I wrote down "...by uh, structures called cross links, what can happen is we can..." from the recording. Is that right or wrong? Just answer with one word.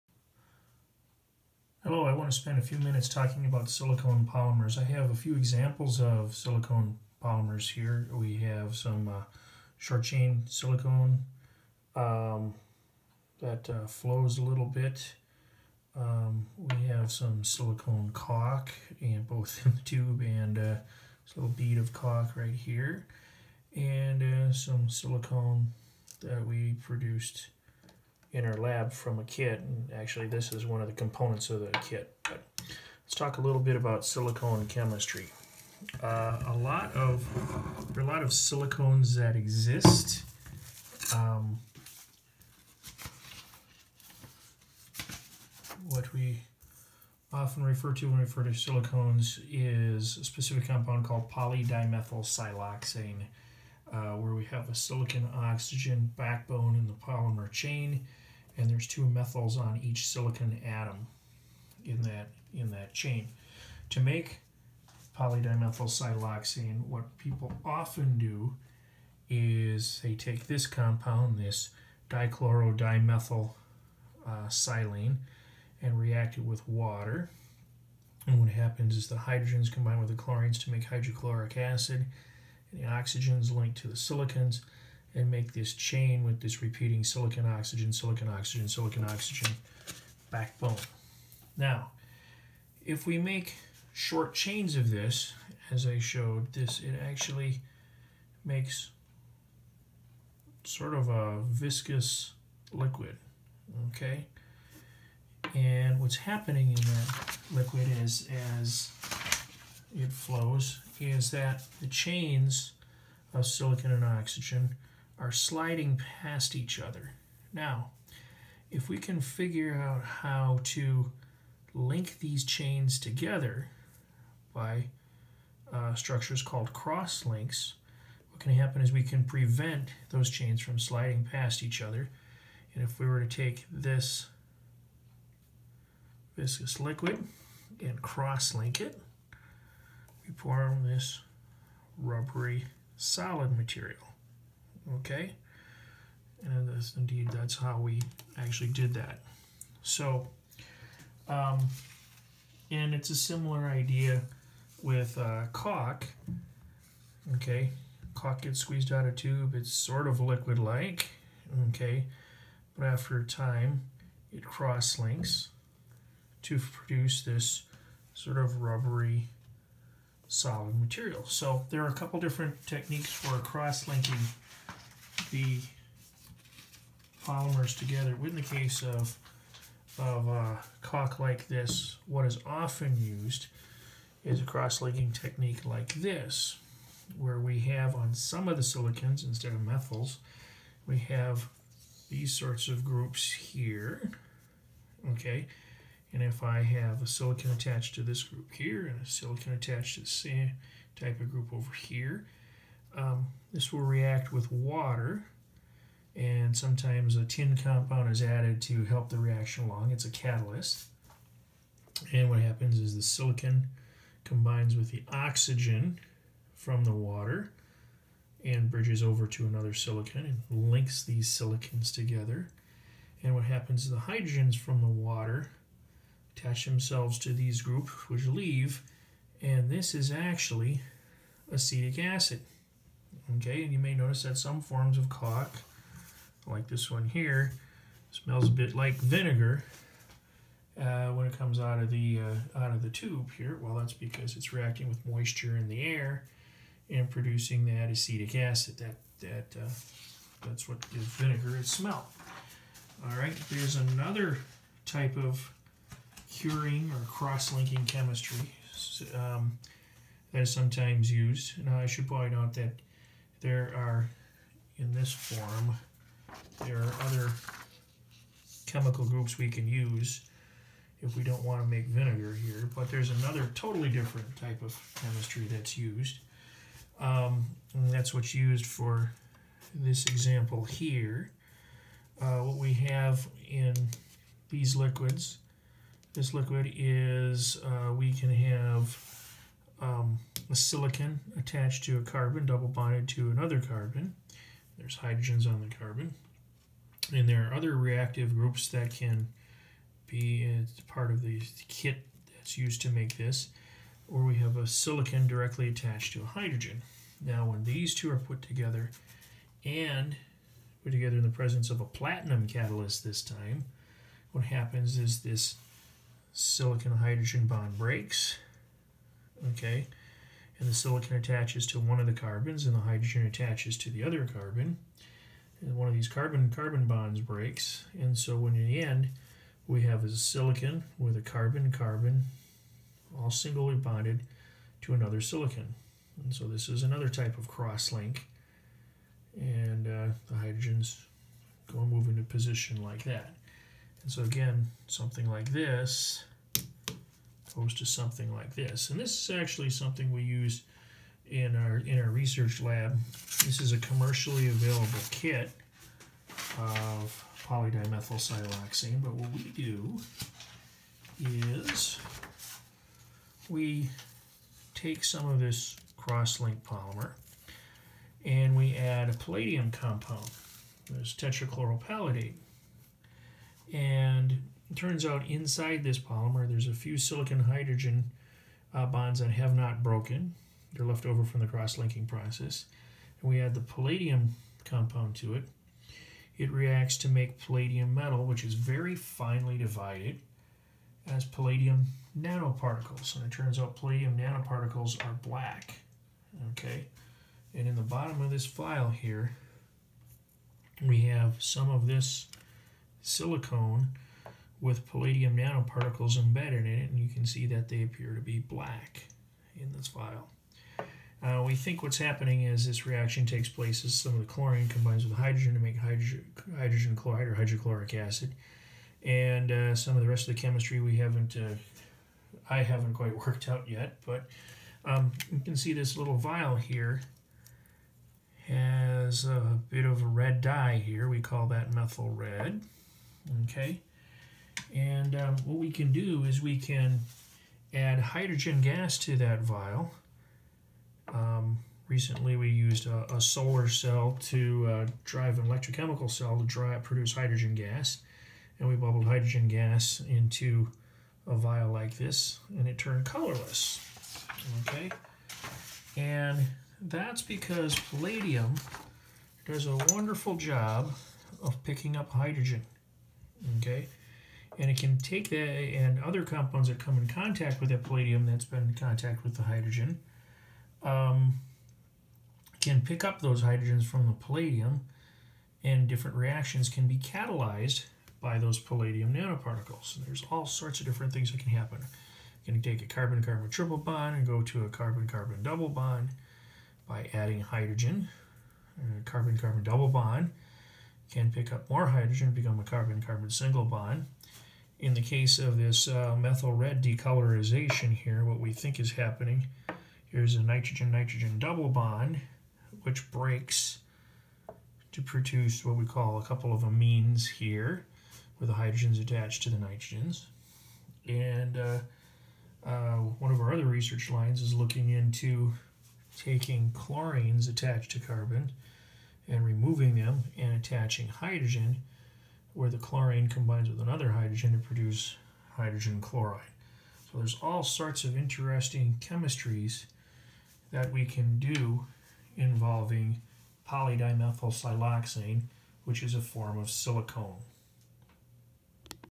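right.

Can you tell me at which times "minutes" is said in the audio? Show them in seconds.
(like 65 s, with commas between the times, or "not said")
2 s.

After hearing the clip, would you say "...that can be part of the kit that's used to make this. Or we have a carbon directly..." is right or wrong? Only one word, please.
wrong.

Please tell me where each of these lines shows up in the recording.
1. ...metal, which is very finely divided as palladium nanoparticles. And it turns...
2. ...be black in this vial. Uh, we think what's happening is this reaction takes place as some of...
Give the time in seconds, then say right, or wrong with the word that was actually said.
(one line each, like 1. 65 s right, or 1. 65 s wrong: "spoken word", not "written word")
1. 387 s right
2. 408 s right.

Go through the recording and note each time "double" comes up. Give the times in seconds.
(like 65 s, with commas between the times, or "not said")
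292 s, 485 s, 489 s, 501 s.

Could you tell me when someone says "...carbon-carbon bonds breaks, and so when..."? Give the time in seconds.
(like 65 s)
326 s.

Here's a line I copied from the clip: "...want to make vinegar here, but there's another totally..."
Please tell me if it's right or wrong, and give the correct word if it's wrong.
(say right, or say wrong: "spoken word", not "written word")
right.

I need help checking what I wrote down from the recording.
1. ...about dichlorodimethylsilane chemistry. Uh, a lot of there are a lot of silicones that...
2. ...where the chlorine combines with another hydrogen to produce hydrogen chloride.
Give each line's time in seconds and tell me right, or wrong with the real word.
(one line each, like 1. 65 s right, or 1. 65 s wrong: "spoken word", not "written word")
1. 33 s wrong: "silicone", not "dichlorodimethylsilane"
2. 522 s right.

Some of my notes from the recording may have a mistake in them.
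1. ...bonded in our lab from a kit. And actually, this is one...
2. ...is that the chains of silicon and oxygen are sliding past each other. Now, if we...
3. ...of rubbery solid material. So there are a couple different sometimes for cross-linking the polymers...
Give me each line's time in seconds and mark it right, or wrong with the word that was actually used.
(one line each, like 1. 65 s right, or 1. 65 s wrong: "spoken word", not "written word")
1. 26 s wrong: "produced", not "bonded"
2. 110 s right
3. 168 s wrong: "techniques", not "sometimes".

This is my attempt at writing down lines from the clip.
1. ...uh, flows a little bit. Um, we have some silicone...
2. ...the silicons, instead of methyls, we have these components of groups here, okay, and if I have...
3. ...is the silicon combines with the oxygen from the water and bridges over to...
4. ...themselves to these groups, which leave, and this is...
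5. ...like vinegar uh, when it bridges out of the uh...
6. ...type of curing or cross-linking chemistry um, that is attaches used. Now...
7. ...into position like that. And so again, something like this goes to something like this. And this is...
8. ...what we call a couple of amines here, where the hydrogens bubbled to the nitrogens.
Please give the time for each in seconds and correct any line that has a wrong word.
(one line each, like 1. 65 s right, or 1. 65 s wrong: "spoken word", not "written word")
1. 13 s right
2. 188 s wrong: "sorts", not "components"
3. 212 s right
4. 226 s right
5. 238 s wrong: "comes", not "bridges"
6. 254 s wrong: "sometimes", not "attaches"
7. 342 s right
8. 505 s wrong: "attached", not "bubbled".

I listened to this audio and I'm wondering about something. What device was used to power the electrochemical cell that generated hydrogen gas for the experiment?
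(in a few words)
solar cell.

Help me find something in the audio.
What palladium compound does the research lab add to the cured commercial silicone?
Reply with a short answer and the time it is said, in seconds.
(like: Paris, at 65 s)
tetrachloropalladate, at 371 s.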